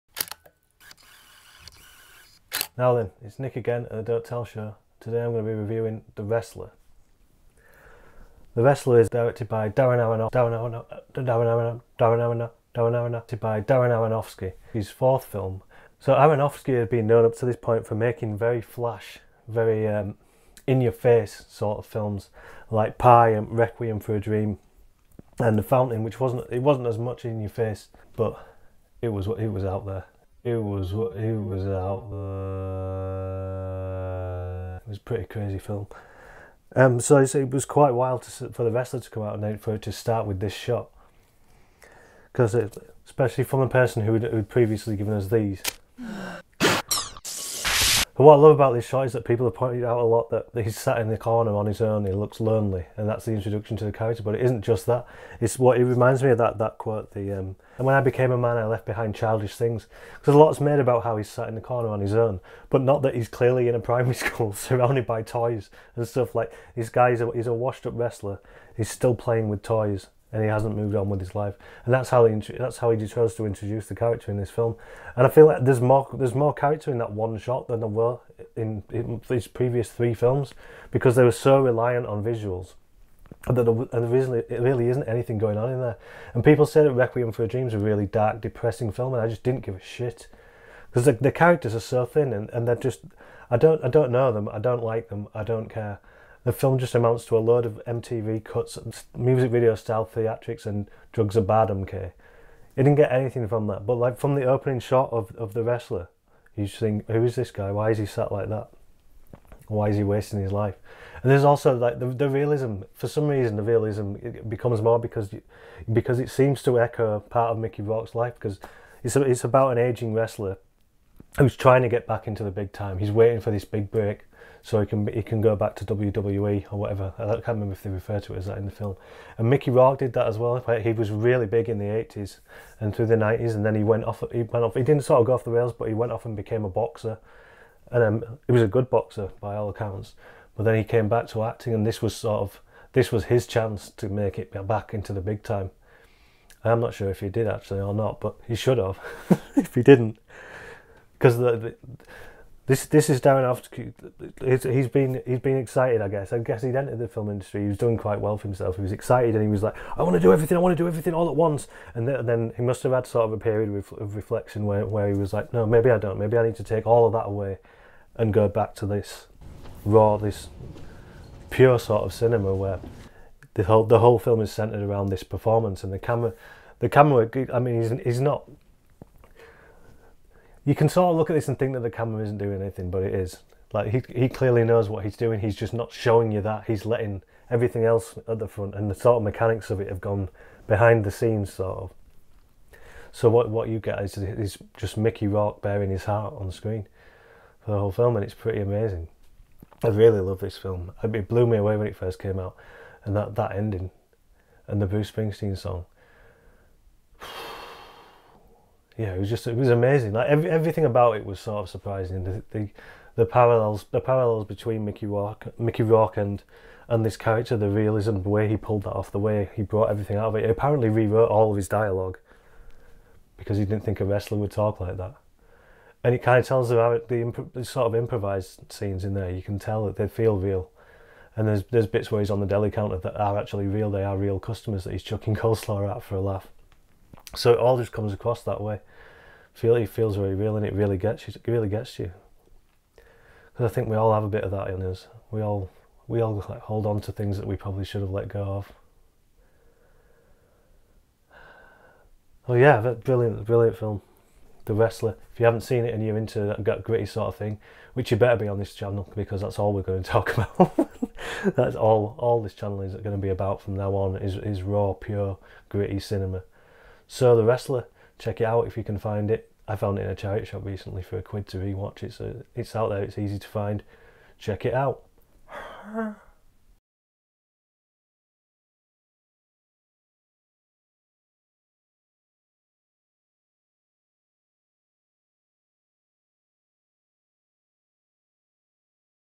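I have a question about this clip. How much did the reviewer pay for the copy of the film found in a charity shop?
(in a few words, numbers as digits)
a quid.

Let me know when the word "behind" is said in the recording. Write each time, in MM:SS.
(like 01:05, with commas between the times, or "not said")
00:58, 03:10.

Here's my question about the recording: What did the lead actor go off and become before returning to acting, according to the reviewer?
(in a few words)
a boxer.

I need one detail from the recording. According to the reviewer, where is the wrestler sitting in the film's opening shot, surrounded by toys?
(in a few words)
primary school.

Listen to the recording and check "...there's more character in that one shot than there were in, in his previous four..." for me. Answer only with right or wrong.
wrong.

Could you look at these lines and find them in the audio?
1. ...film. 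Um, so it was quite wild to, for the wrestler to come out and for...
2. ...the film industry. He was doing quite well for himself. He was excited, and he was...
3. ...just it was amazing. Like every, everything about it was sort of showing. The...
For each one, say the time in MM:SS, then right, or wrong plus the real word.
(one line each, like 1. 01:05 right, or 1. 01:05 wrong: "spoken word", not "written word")
1. 00:35 right
2. 02:36 right
3. 03:29 wrong: "surprising", not "showing".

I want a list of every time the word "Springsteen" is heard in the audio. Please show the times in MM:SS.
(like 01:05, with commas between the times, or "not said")
03:25.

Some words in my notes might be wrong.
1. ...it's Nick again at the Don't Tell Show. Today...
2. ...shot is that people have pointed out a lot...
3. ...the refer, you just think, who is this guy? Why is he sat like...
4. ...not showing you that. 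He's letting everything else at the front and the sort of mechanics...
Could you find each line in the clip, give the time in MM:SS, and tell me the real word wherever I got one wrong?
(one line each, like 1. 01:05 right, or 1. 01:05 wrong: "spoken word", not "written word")
1. 00:03 right
2. 00:48 right
3. 01:45 wrong: "wrestler", not "refer"
4. 03:05 right.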